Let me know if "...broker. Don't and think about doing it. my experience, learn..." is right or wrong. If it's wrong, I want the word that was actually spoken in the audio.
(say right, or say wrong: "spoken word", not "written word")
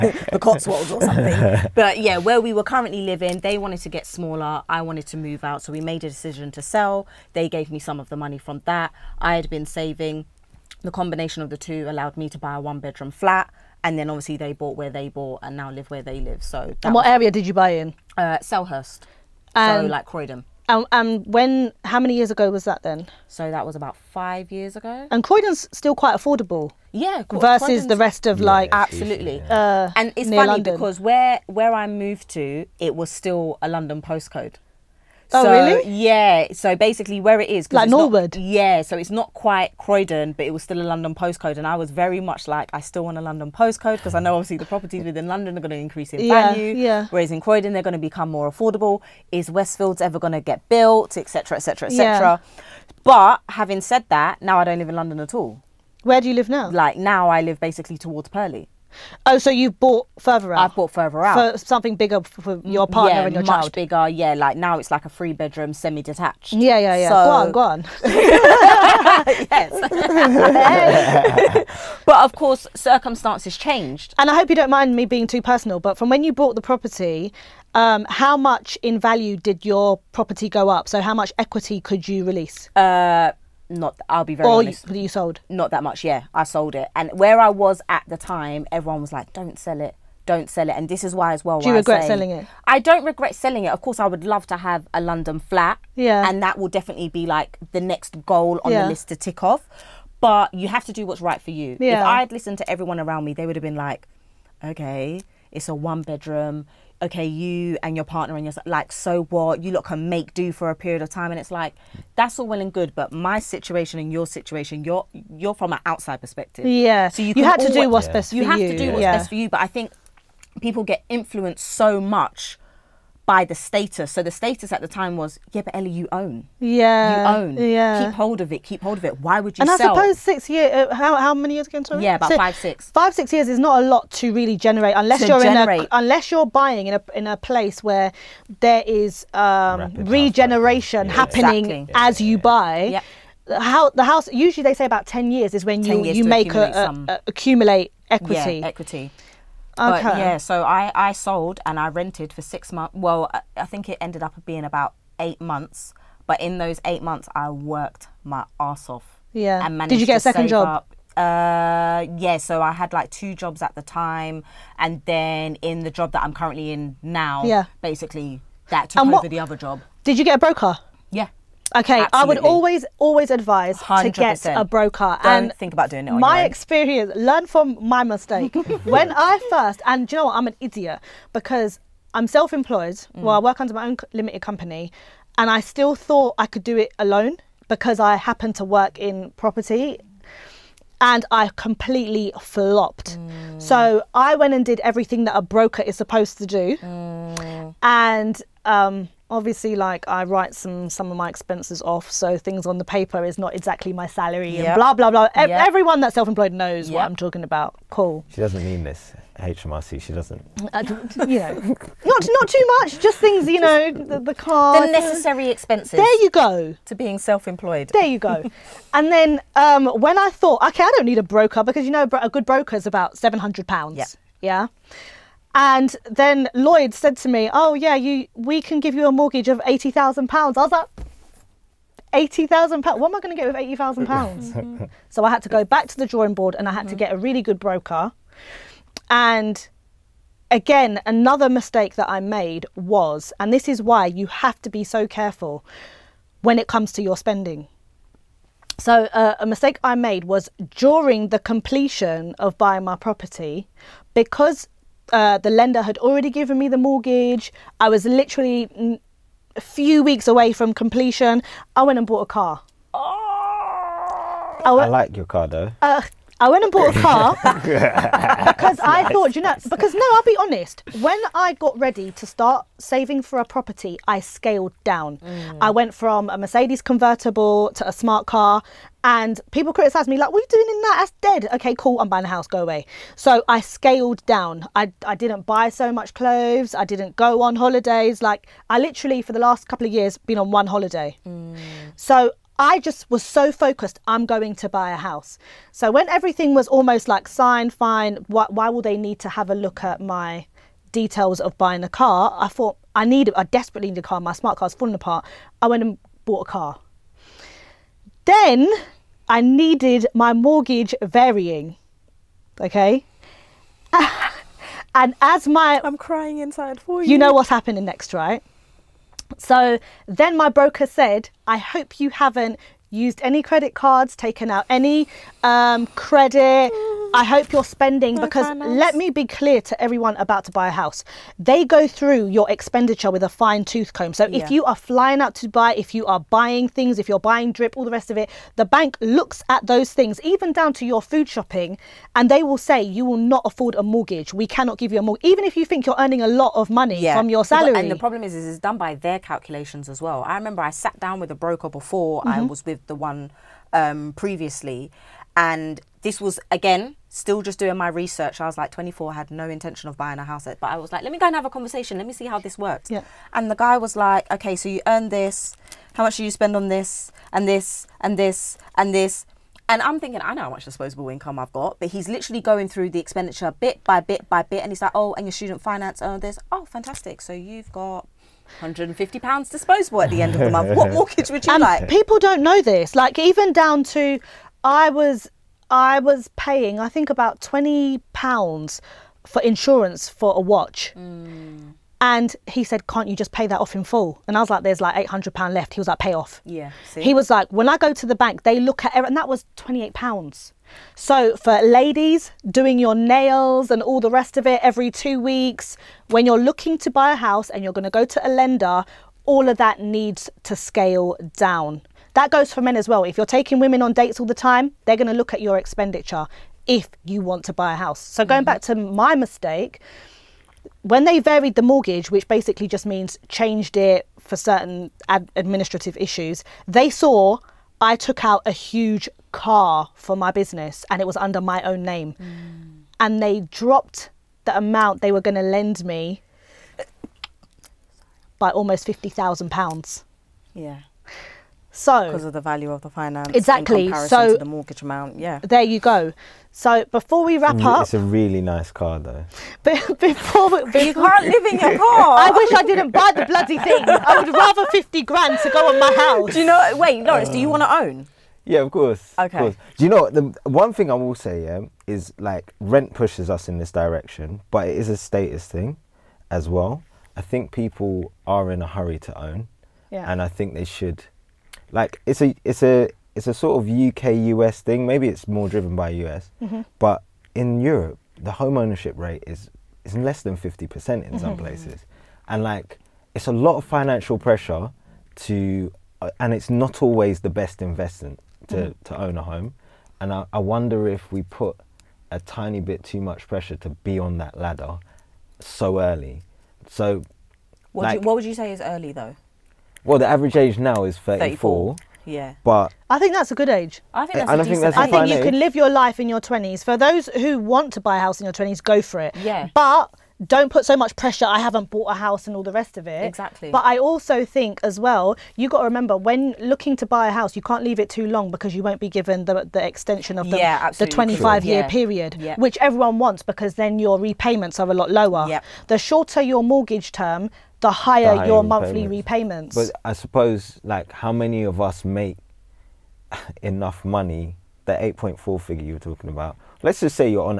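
right.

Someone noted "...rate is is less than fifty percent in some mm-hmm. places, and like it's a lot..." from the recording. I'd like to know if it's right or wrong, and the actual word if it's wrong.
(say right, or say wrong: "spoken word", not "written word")
right.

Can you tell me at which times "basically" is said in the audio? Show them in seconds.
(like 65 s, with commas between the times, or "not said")
36 s, 57 s, 167 s, 422 s.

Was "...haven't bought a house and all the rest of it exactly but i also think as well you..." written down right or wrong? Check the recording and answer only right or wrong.
right.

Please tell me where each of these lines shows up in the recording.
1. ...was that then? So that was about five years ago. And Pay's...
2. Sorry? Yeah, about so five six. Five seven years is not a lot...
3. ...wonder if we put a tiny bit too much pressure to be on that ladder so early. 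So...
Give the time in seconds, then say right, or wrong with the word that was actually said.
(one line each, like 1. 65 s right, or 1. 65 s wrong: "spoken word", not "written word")
1. 22 s wrong: "Croydon", not "Pay"
2. 131 s wrong: "six", not "seven"
3. 490 s right.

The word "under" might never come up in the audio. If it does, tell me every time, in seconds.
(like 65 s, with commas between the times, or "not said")
183 s, 431 s.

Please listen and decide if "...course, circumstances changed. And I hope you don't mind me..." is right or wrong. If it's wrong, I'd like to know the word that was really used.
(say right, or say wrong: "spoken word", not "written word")
right.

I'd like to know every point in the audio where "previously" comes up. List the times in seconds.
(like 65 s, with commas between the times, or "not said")
354 s.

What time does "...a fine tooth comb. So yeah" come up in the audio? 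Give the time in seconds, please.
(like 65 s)
333 s.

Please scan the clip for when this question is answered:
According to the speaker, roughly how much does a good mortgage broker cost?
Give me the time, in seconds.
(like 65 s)
223 s.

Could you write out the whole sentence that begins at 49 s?
Is Westfields ever going to get built, etc., etc., etc.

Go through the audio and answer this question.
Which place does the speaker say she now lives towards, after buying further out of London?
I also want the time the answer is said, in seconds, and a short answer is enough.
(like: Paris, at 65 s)
Purley, at 58 s.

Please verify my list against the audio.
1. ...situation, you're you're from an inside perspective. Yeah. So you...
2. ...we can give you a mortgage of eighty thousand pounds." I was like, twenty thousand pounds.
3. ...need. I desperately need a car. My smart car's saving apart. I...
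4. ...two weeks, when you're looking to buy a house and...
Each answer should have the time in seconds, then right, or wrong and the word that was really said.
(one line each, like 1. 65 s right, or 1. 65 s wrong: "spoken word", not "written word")
1. 114 s wrong: "outside", not "inside"
2. 228 s wrong: "eighty", not "twenty"
3. 303 s wrong: "falling", not "saving"
4. 404 s right.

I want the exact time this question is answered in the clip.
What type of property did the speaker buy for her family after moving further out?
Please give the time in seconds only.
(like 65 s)
65 s.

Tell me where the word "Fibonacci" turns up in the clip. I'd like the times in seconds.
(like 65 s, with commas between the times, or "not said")
not said.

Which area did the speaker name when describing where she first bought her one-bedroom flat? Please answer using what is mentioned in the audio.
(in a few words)
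Selhurst.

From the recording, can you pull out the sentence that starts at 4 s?
I wanted to move out, so we made a decision to sell.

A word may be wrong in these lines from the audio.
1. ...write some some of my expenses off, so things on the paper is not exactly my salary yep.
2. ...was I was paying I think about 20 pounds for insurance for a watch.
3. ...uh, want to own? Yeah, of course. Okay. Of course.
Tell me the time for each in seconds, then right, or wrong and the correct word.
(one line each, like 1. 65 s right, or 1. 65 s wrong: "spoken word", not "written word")
1. 200 s right
2. 384 s right
3. 457 s right.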